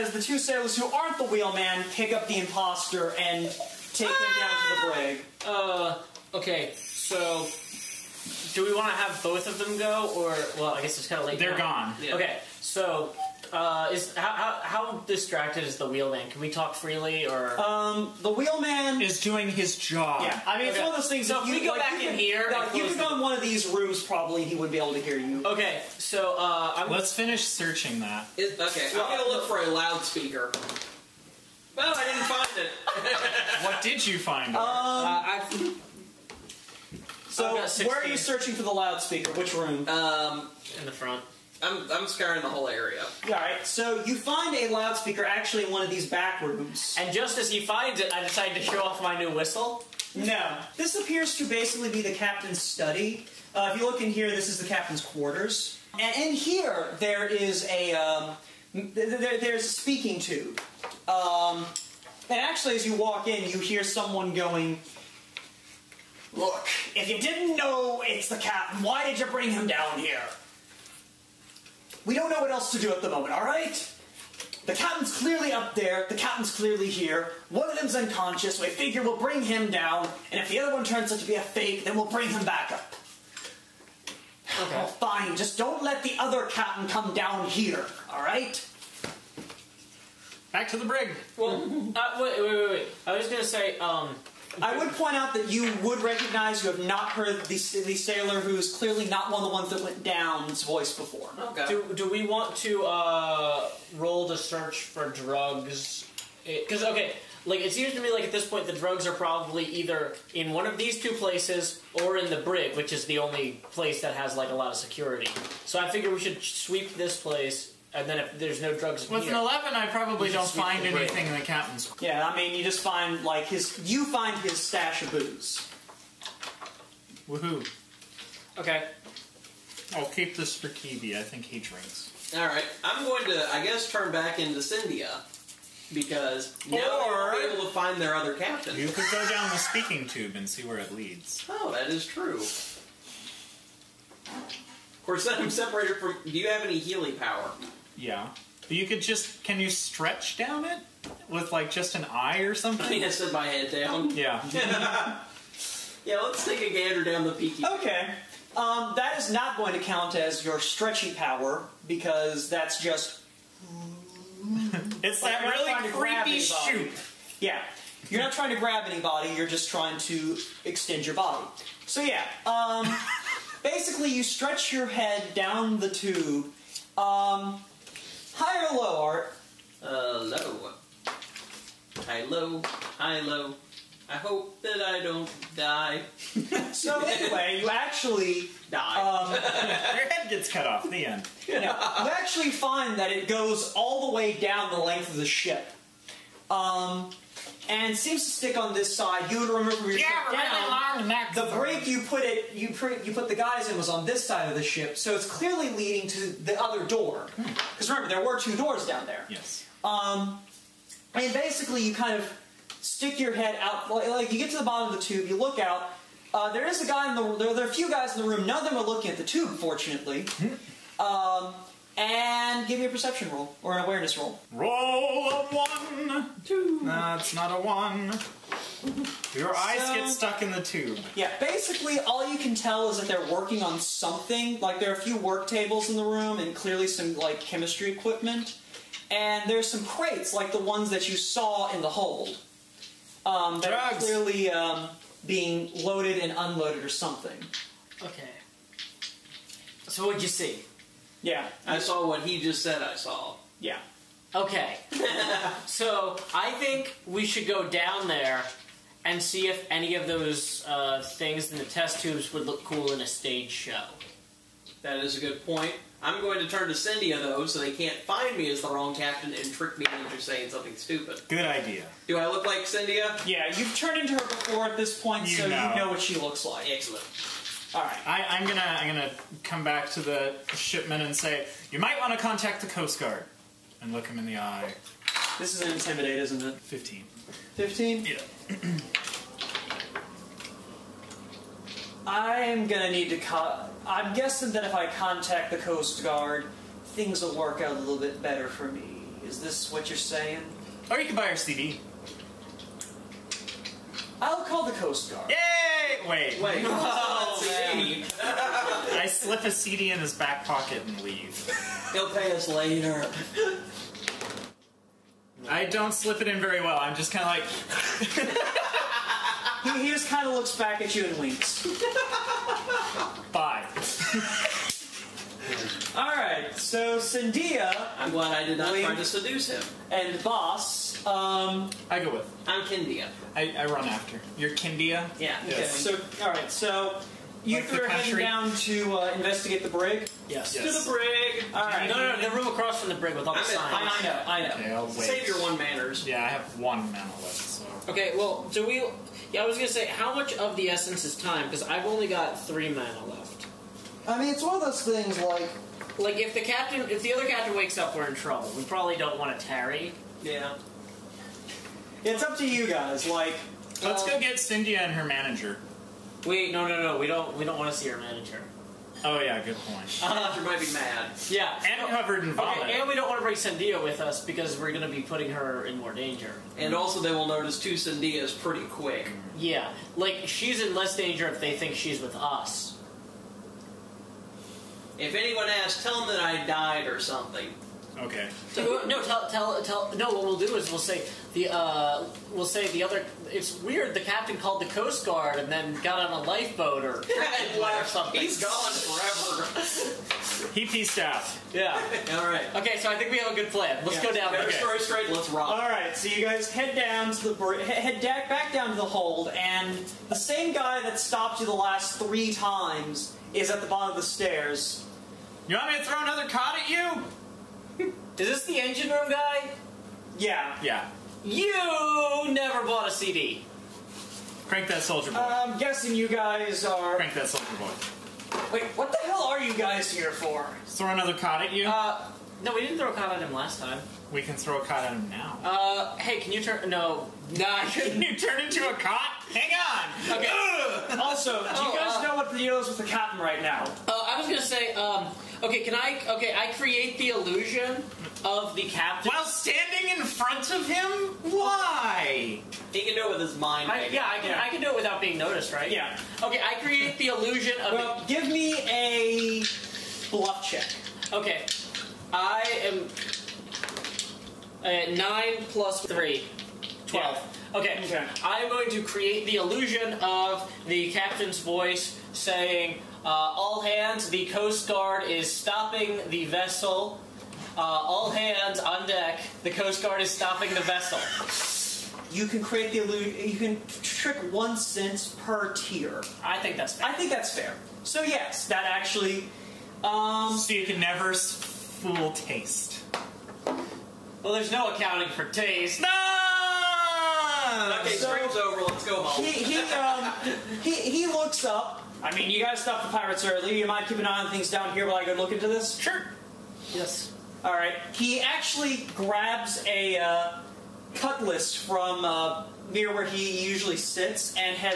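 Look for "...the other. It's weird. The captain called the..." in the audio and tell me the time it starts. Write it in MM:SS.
06:32.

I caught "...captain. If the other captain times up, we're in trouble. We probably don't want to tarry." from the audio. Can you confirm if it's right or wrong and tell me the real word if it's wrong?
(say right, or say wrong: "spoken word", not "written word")
wrong: "wakes", not "times".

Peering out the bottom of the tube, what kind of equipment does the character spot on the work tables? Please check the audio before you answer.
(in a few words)
Chemistry equipment.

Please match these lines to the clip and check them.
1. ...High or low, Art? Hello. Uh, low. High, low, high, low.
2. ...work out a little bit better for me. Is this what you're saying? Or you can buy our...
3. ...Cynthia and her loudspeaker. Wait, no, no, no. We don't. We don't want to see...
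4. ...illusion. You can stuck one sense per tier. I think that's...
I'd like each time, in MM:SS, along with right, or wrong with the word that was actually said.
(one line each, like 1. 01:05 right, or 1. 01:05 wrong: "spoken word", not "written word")
1. 02:58 right
2. 04:57 right
3. 06:04 wrong: "manager", not "loudspeaker"
4. 08:02 wrong: "trick", not "stuck".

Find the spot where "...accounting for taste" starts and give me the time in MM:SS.
08:14.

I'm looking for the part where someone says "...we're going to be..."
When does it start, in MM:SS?
06:14.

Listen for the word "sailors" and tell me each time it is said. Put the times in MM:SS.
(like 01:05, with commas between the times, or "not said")
00:00, 01:37.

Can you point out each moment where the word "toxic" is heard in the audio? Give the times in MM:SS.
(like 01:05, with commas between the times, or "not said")
not said.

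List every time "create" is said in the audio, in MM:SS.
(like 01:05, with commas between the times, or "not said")
07:26, 07:36, 07:48, 08:02.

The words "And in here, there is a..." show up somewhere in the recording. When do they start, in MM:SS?
00:55.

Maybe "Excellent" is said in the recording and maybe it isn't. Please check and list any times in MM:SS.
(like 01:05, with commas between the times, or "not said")
04:36.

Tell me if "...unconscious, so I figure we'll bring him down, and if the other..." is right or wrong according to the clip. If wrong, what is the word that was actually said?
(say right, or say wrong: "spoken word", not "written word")
right.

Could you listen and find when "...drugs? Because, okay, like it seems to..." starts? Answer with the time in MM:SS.
01:45.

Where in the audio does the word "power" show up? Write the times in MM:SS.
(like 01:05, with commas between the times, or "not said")
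02:27, 02:41.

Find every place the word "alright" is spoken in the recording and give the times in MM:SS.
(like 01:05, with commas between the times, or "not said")
01:13, 01:28, 05:41.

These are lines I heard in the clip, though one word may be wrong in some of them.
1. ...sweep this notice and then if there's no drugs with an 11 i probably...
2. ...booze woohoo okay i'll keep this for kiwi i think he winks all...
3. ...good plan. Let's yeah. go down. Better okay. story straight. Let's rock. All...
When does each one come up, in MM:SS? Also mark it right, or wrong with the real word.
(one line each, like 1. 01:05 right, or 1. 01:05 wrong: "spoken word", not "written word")
1. 01:56 wrong: "place", not "notice"
2. 02:05 wrong: "drinks", not "winks"
3. 06:43 right.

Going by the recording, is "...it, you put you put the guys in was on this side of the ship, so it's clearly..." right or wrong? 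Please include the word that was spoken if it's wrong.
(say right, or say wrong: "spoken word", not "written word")
right.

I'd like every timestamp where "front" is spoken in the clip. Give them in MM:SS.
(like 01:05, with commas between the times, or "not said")
00:40, 07:30.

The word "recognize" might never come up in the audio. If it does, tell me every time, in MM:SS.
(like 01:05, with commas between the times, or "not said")
01:36.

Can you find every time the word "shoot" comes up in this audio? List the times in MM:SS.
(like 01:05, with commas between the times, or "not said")
02:46.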